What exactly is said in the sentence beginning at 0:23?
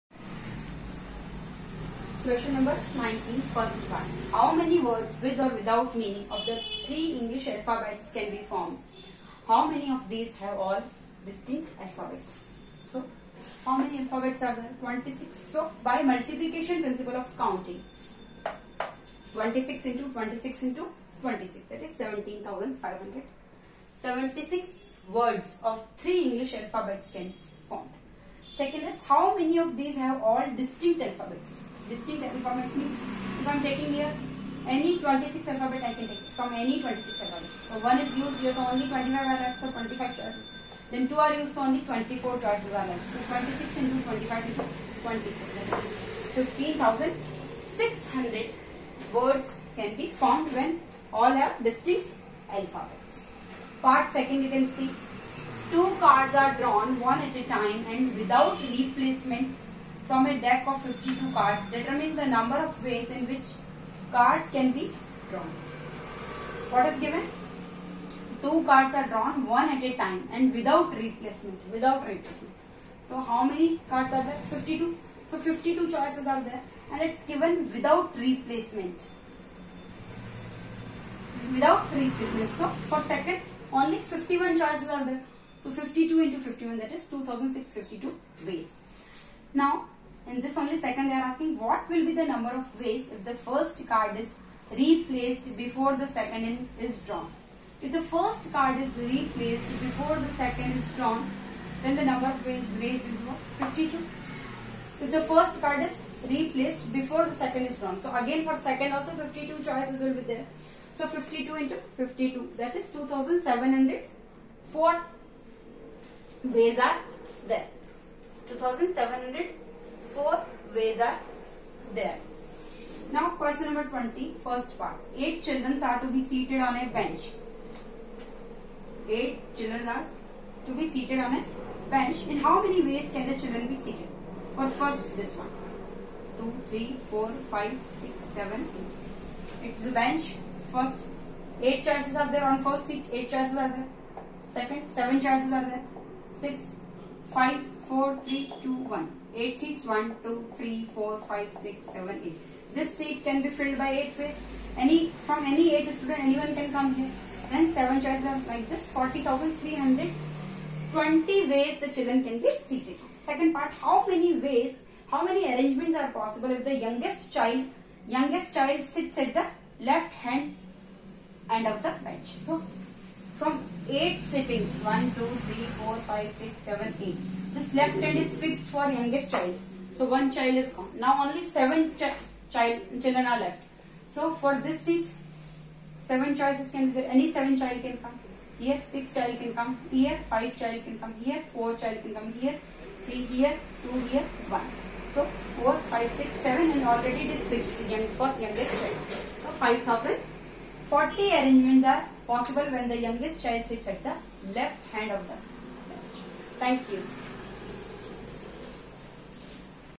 76 words of three English alphabets can Second is how many of these have all distinct alphabets.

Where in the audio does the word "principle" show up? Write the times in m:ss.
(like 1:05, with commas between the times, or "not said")
0:16.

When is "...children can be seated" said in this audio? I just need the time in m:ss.
2:41.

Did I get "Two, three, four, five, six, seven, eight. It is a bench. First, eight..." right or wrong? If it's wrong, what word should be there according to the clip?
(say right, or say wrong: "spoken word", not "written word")
right.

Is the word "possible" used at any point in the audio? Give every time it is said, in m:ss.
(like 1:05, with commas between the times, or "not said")
2:46, 3:22.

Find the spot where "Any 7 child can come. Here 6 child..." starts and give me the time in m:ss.
3:07.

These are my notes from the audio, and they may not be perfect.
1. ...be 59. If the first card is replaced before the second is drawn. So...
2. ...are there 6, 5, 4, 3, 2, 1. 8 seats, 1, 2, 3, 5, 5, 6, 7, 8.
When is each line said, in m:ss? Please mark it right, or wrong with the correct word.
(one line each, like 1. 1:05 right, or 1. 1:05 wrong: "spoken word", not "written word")
1. 1:42 wrong: "52", not "59"
2. 2:25 wrong: "4", not "5".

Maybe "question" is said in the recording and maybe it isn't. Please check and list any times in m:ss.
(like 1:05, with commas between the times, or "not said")
0:02, 2:03.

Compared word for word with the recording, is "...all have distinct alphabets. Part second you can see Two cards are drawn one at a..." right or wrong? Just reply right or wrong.
right.